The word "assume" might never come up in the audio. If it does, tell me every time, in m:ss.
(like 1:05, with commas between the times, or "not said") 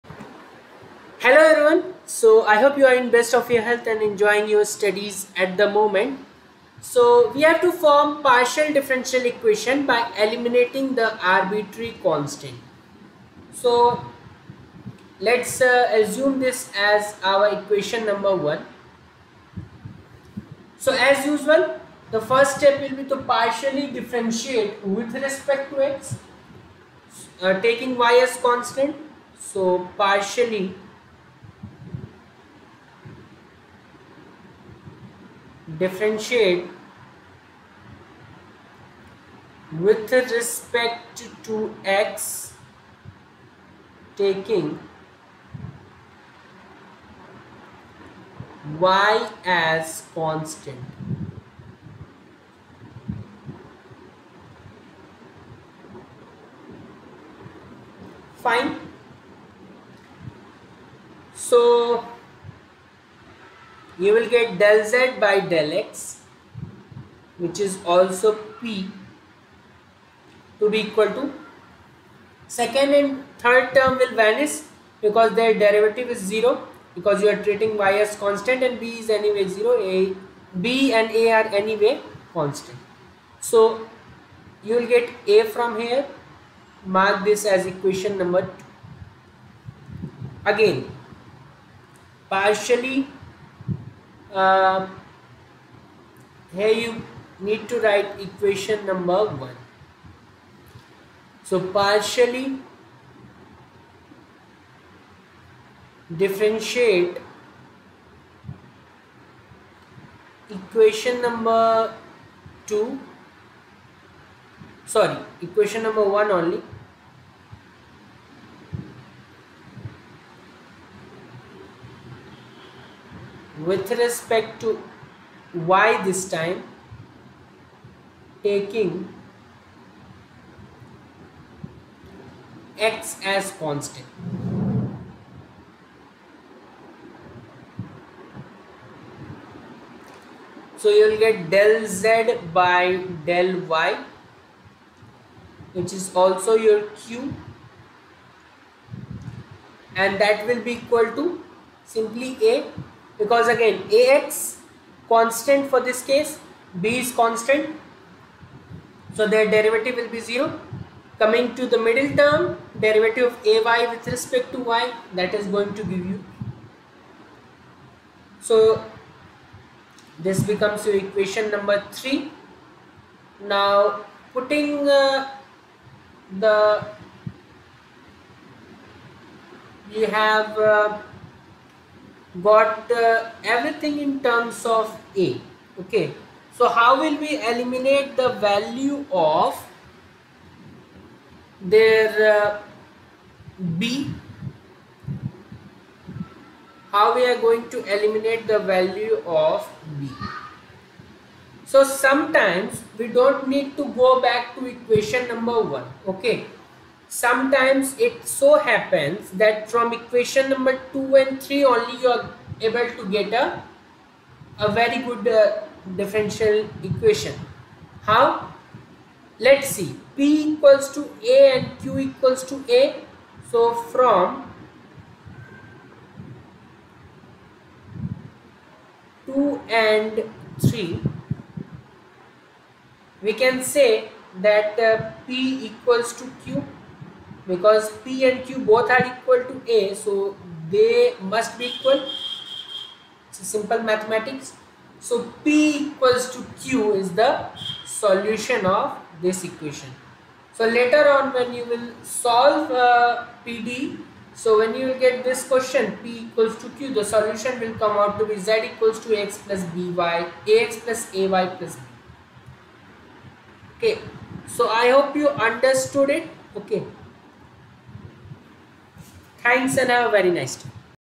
0:15.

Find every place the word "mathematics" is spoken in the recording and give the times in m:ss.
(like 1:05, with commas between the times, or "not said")
4:03.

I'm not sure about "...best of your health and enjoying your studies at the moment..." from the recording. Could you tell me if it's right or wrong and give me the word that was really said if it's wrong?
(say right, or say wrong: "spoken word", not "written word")
right.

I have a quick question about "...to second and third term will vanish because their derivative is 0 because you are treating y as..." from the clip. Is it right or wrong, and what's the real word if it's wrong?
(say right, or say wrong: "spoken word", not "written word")
right.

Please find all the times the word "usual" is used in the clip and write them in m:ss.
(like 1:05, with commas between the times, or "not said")
0:21.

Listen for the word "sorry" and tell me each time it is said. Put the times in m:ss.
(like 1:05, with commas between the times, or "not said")
1:54.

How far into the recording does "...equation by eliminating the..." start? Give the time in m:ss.
0:09.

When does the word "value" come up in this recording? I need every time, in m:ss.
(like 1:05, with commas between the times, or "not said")
3:08, 3:18.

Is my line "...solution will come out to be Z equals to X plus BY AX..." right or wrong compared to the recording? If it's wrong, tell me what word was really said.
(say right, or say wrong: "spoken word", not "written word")
right.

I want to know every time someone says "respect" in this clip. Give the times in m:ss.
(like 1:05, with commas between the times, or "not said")
0:25, 0:40, 2:03, 2:44.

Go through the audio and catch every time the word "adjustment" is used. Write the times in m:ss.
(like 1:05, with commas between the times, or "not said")
not said.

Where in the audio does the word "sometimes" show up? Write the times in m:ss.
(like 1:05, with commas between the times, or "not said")
3:21, 3:27.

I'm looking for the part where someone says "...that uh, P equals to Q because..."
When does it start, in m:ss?
3:54.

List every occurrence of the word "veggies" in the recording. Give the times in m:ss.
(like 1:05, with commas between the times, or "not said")
not said.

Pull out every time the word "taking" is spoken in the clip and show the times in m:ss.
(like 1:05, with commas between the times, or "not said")
0:27, 0:44, 2:08.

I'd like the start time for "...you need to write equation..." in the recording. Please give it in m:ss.
1:36.